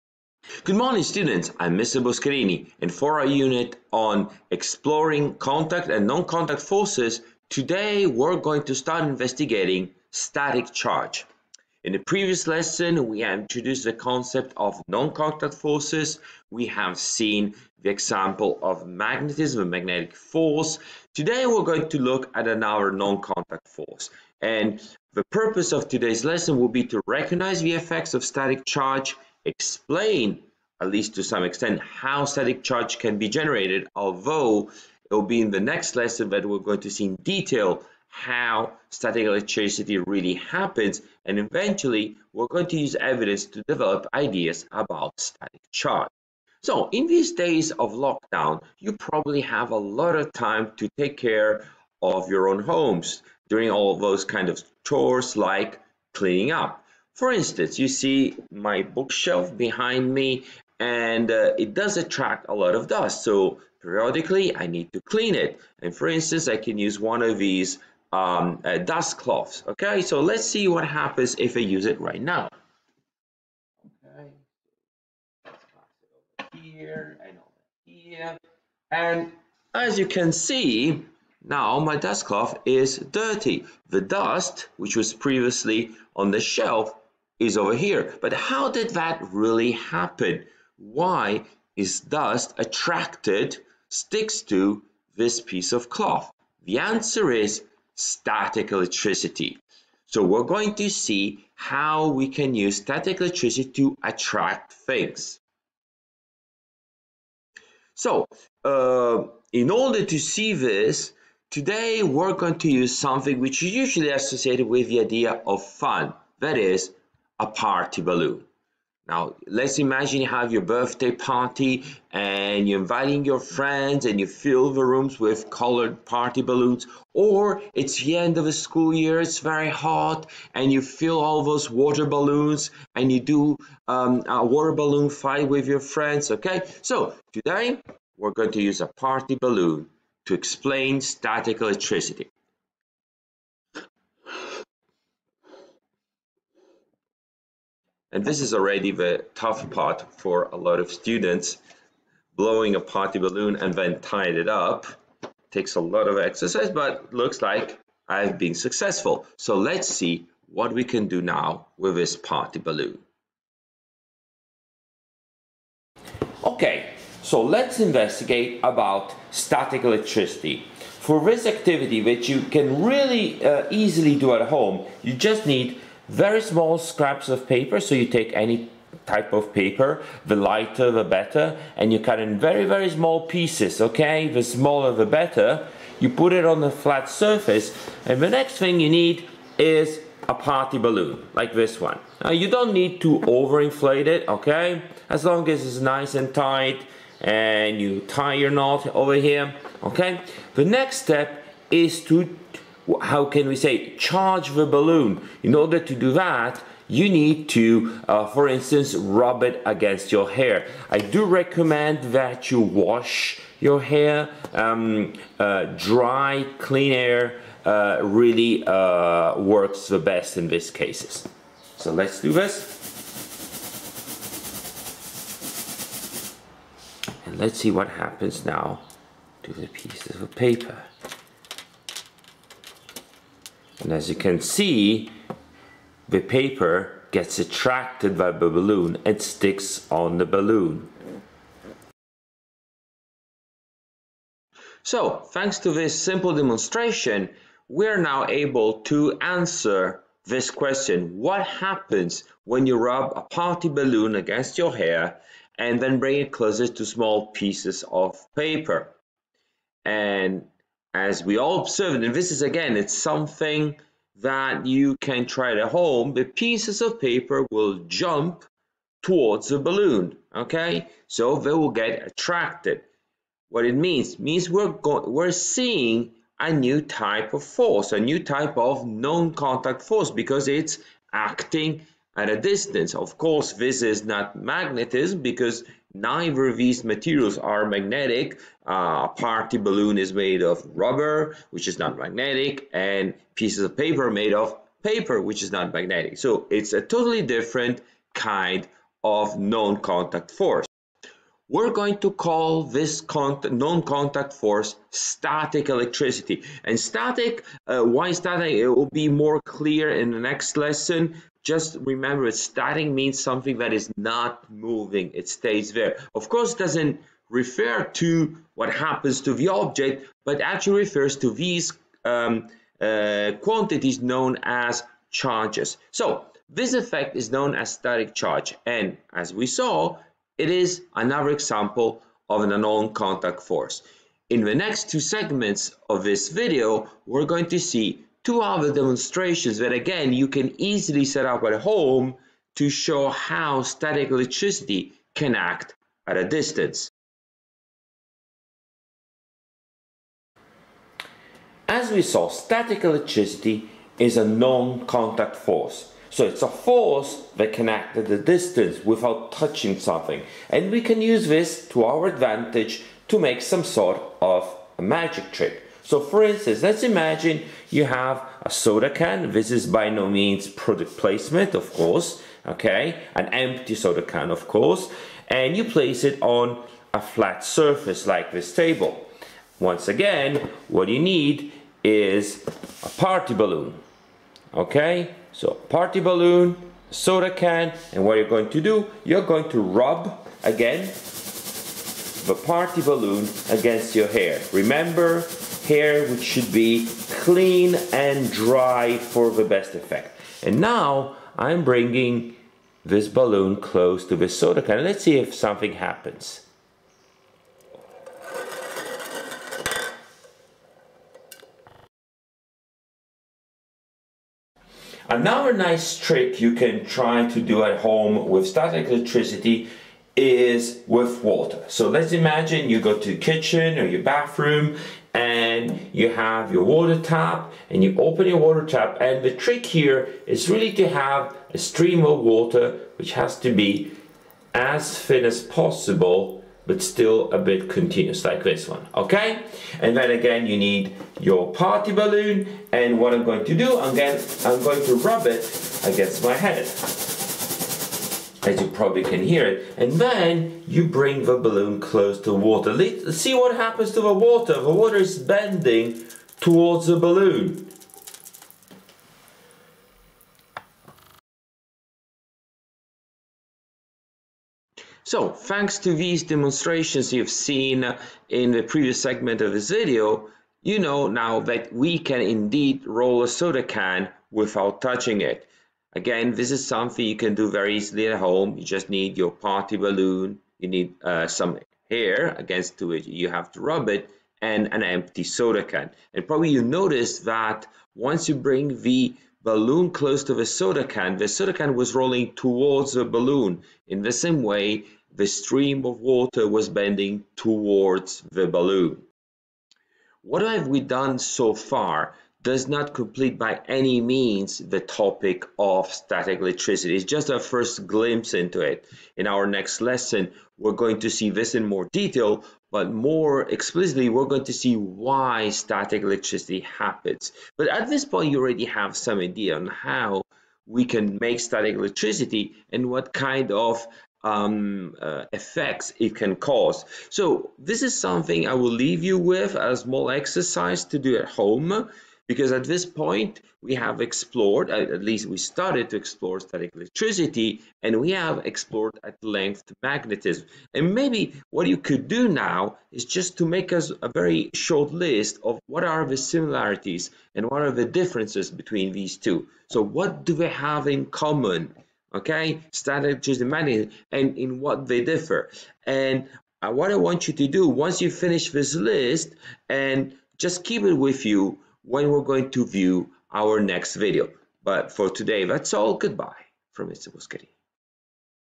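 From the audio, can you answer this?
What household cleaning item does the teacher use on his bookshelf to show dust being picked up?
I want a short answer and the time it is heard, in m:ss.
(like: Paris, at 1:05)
Dust cloth, at 1:08.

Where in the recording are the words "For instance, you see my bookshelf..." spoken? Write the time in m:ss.
0:57.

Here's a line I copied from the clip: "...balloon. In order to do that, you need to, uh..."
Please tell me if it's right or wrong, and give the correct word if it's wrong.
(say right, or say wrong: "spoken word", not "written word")
right.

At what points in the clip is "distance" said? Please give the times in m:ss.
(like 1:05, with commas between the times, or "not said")
4:42, 5:46, 5:58.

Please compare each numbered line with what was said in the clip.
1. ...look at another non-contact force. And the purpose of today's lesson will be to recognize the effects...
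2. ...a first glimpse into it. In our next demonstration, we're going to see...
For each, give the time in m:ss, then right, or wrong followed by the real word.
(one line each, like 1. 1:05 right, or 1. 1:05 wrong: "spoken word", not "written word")
1. 0:21 right
2. 8:27 wrong: "lesson", not "demonstration".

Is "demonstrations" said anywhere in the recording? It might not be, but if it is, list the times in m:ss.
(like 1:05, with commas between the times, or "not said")
4:06, 5:38, 7:46.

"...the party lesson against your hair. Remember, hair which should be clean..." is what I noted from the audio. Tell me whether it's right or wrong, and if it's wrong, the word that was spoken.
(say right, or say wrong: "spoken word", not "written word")
wrong: "balloon", not "lesson".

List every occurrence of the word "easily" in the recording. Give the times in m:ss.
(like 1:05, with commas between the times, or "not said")
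2:53, 5:40, 7:57.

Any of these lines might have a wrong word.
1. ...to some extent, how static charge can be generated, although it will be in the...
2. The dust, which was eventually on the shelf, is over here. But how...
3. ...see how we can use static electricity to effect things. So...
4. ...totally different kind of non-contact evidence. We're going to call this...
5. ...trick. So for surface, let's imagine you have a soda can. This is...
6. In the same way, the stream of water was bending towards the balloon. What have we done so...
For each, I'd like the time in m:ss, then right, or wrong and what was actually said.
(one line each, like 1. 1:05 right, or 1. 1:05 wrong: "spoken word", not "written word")
1. 0:31 right
2. 1:23 wrong: "previously", not "eventually"
3. 1:40 wrong: "attract", not "effect"
4. 4:56 wrong: "force", not "evidence"
5. 6:05 wrong: "instance", not "surface"
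6. 8:13 right.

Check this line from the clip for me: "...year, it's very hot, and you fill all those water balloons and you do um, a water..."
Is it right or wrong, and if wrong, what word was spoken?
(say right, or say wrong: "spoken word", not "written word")
right.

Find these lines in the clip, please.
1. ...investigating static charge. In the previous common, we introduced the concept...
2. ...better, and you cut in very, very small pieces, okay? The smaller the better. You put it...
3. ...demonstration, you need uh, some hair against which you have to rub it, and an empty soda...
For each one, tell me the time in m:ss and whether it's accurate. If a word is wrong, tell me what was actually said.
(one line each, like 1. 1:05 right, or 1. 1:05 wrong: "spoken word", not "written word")
1. 0:09 wrong: "lesson", not "common"
2. 3:01 right
3. 7:59 wrong: "balloon", not "demonstration".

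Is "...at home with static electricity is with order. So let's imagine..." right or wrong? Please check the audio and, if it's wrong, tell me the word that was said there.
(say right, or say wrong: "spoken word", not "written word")
wrong: "water", not "order".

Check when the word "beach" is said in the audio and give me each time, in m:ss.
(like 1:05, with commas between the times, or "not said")
not said.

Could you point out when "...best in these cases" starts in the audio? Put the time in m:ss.
3:39.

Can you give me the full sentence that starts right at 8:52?
Because at this point, we have explored, at least we started to explore static electricity, and we have explored at length magnetism.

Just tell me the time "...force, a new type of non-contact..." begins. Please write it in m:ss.
4:37.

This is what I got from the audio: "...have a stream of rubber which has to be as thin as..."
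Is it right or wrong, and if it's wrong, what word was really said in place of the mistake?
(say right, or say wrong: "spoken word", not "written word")
wrong: "water", not "rubber".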